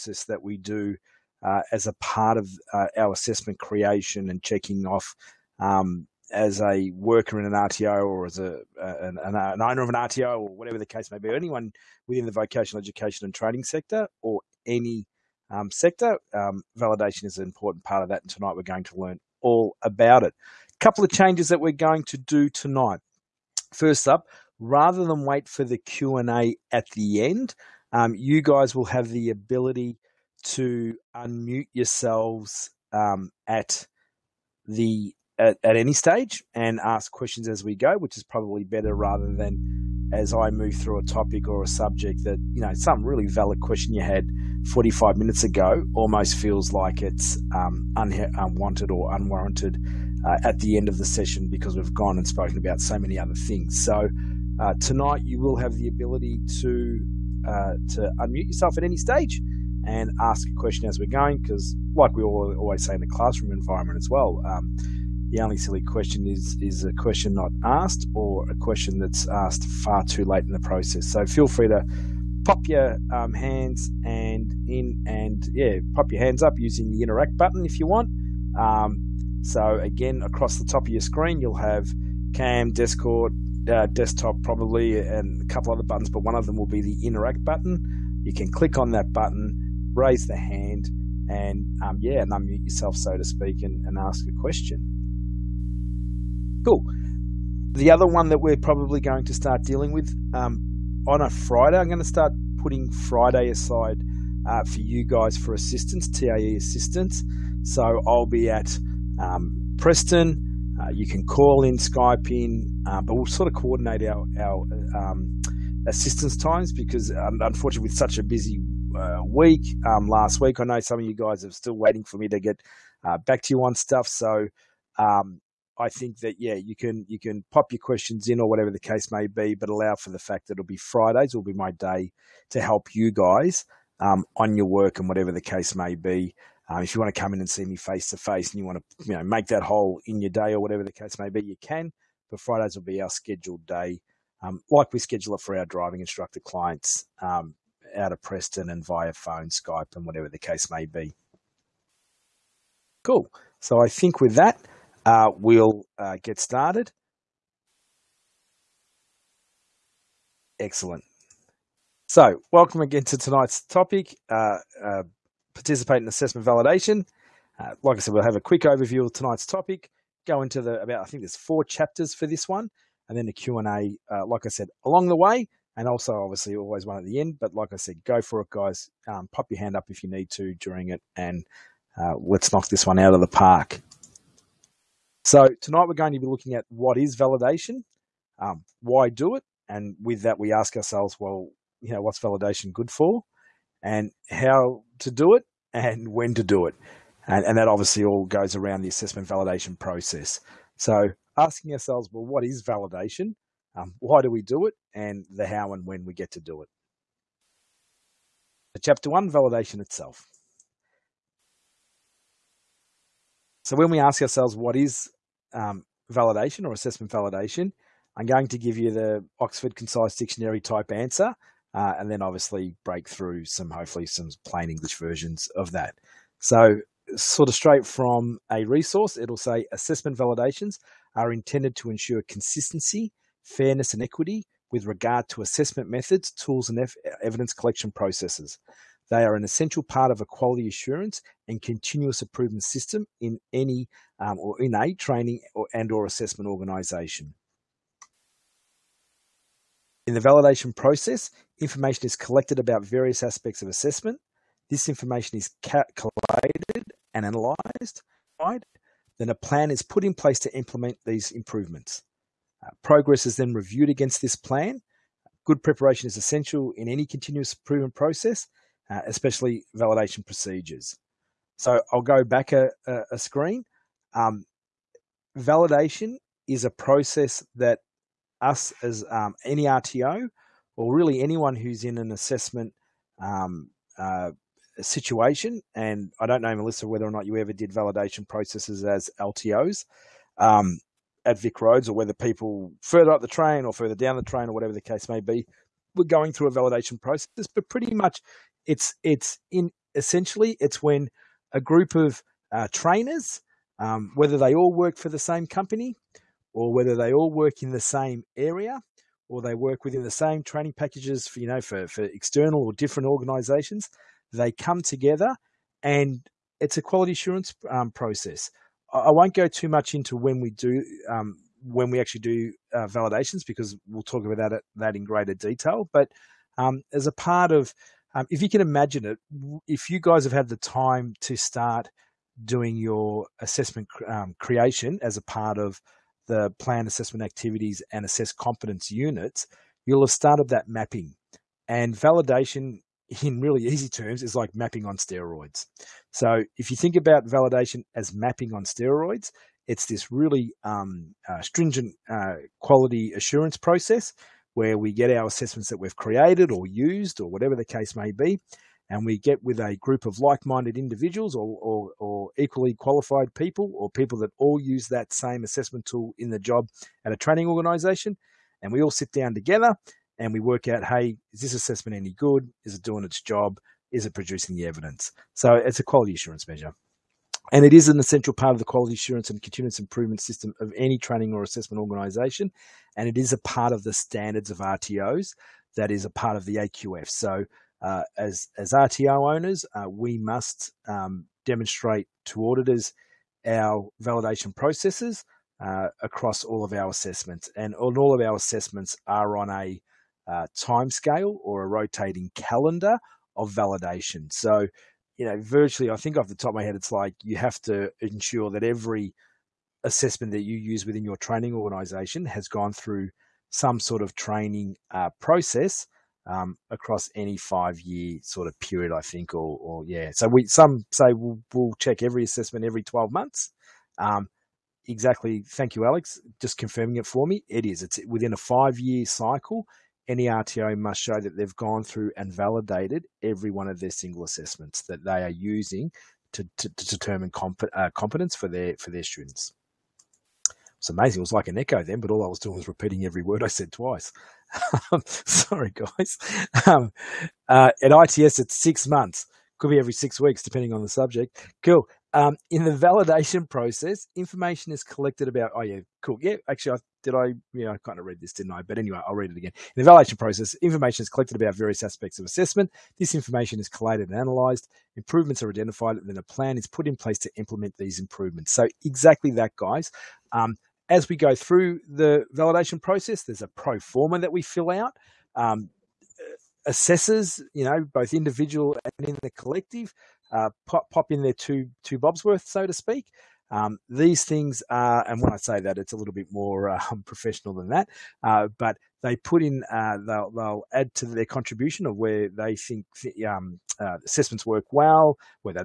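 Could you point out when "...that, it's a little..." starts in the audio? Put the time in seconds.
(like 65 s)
485 s.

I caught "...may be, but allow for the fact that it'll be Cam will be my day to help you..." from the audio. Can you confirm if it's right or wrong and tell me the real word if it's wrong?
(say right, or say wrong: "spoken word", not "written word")
wrong: "Fridays", not "Cam".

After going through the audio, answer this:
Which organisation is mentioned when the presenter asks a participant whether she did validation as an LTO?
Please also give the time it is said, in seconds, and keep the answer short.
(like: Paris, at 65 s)
VicRoads, at 291 s.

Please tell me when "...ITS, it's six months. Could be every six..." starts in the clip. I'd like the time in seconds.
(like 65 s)
447 s.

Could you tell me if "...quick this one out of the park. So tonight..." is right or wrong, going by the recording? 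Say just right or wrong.
wrong.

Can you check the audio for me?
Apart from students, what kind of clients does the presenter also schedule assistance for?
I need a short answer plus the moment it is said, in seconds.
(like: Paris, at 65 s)
driving instructor clients, at 145 s.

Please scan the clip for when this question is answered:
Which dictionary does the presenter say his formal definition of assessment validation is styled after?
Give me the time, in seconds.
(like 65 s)
219 s.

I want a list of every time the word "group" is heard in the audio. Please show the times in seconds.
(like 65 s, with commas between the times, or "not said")
301 s, 359 s.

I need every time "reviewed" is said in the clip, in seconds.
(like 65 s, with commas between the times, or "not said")
263 s.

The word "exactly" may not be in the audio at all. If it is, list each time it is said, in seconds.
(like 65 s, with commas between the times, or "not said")
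424 s, 468 s.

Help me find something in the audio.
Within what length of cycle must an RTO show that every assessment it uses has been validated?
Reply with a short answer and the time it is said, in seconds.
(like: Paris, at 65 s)
5 years, at 428 s.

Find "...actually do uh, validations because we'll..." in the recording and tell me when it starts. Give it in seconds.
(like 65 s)
321 s.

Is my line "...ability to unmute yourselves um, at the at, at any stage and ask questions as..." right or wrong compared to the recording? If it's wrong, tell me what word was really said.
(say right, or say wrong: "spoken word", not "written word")
right.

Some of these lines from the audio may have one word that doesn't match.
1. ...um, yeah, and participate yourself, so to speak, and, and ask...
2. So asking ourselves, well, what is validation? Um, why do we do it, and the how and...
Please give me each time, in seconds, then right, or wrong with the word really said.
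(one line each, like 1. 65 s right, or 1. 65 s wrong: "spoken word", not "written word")
1. 91 s wrong: "unmute", not "participate"
2. 200 s right.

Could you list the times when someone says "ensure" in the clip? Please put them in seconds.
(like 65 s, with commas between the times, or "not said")
231 s, 407 s.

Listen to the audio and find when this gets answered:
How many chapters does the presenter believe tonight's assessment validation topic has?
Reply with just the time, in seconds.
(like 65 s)
171 s.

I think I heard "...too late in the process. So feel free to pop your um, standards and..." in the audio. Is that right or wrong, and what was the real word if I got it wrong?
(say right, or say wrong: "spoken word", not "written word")
wrong: "hands", not "standards".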